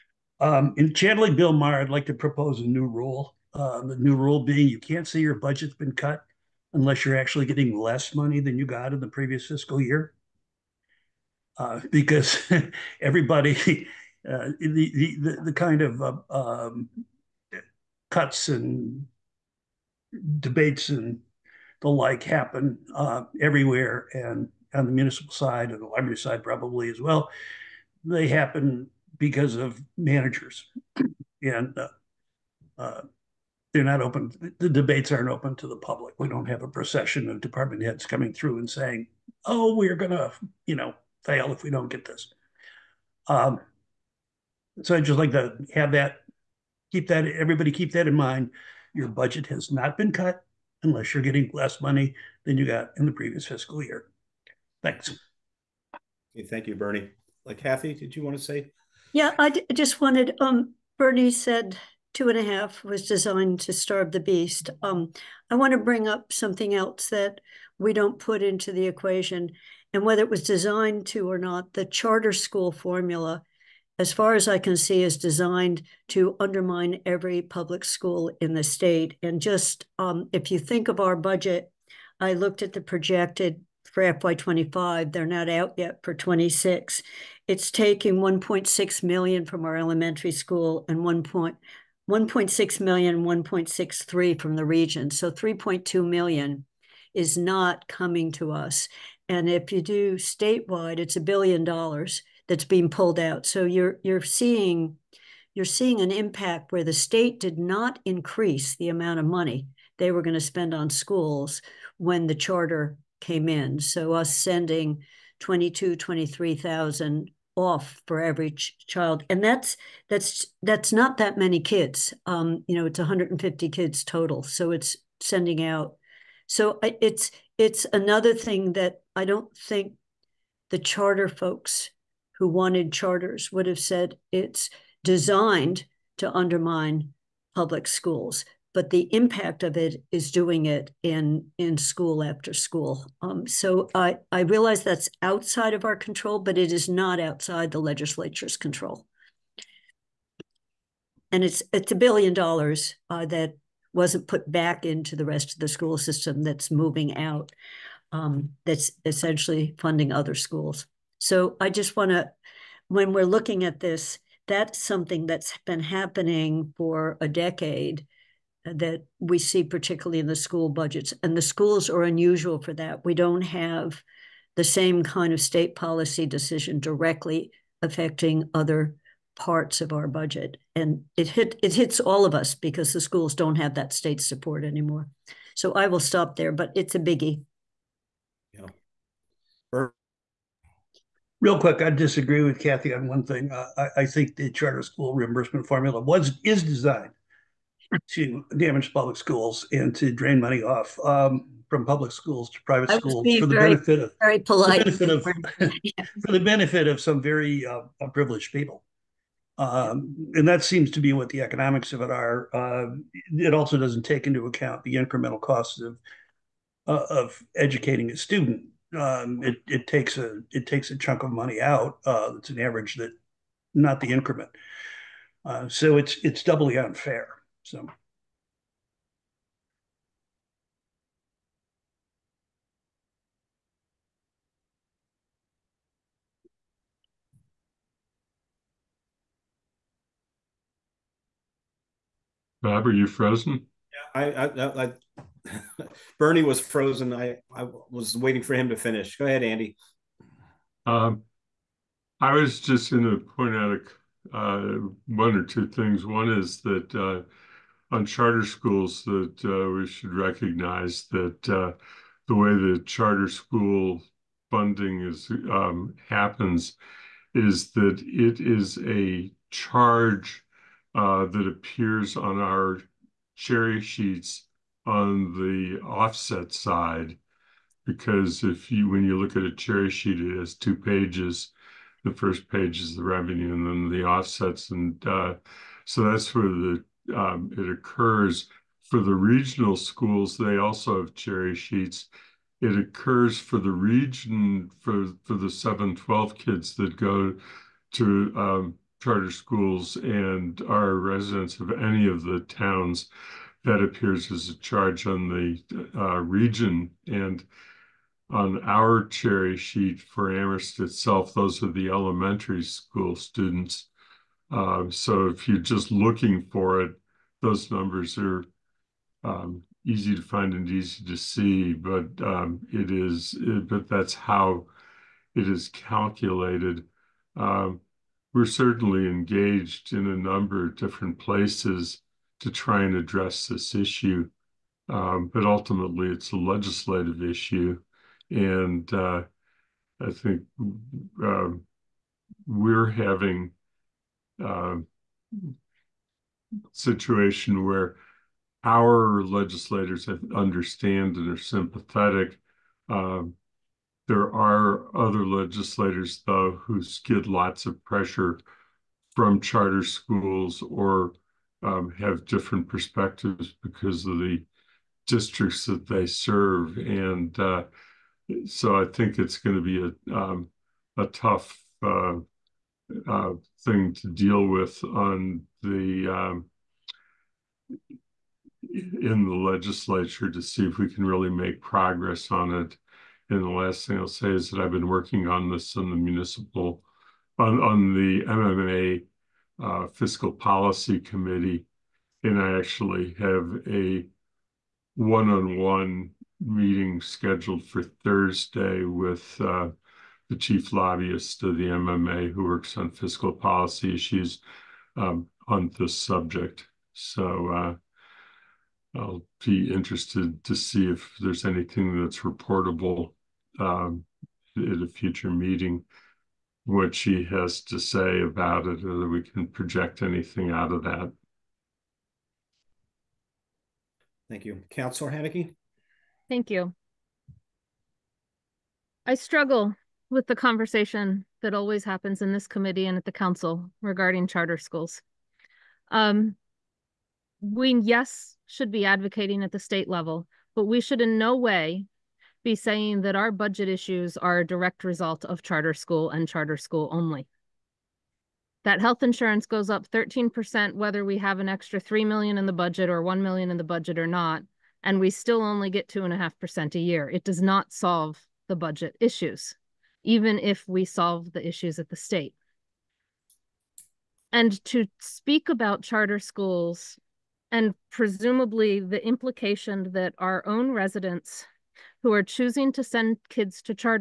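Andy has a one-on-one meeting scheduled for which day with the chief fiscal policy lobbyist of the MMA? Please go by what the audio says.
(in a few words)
Thursday.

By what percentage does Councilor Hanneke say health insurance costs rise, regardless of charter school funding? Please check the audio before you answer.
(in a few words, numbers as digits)
13%.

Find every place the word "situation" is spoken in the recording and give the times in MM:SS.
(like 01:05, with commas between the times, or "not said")
05:46.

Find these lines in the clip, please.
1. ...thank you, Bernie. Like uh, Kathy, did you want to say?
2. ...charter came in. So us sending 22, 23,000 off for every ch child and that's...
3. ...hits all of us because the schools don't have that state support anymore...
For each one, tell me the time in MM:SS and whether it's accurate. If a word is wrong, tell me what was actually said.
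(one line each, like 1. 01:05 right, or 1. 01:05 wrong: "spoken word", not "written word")
1. 00:56 right
2. 01:52 right
3. 03:01 right.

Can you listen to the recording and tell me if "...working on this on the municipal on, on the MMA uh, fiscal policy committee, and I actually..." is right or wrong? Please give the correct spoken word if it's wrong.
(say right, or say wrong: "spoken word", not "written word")
right.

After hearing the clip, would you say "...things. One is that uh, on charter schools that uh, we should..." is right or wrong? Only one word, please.
right.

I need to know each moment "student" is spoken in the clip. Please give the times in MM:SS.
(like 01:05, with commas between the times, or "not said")
03:38, 05:13.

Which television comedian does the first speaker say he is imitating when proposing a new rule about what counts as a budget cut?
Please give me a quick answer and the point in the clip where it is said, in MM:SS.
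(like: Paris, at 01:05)
Bill Maher, at 00:01.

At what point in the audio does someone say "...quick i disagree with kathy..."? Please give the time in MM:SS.
03:11.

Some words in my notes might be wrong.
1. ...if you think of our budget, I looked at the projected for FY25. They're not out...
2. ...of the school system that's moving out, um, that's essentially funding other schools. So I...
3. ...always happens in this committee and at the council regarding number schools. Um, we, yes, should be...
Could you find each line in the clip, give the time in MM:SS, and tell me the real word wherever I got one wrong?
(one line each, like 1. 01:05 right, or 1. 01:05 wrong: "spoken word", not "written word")
1. 01:20 right
2. 02:35 right
3. 07:11 wrong: "charter", not "number".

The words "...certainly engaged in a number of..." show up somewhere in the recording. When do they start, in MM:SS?
05:28.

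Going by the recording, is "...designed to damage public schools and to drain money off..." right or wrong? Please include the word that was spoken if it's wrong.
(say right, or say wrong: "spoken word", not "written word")
right.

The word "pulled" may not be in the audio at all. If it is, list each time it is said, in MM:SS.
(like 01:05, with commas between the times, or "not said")
01:42.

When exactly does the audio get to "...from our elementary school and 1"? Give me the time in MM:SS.
01:29.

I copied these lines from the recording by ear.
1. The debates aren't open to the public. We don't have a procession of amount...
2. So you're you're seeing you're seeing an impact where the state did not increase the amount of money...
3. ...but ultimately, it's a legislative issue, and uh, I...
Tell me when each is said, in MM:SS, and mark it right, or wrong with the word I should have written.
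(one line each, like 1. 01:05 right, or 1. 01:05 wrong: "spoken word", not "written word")
1. 00:34 wrong: "department", not "amount"
2. 01:43 right
3. 05:34 right.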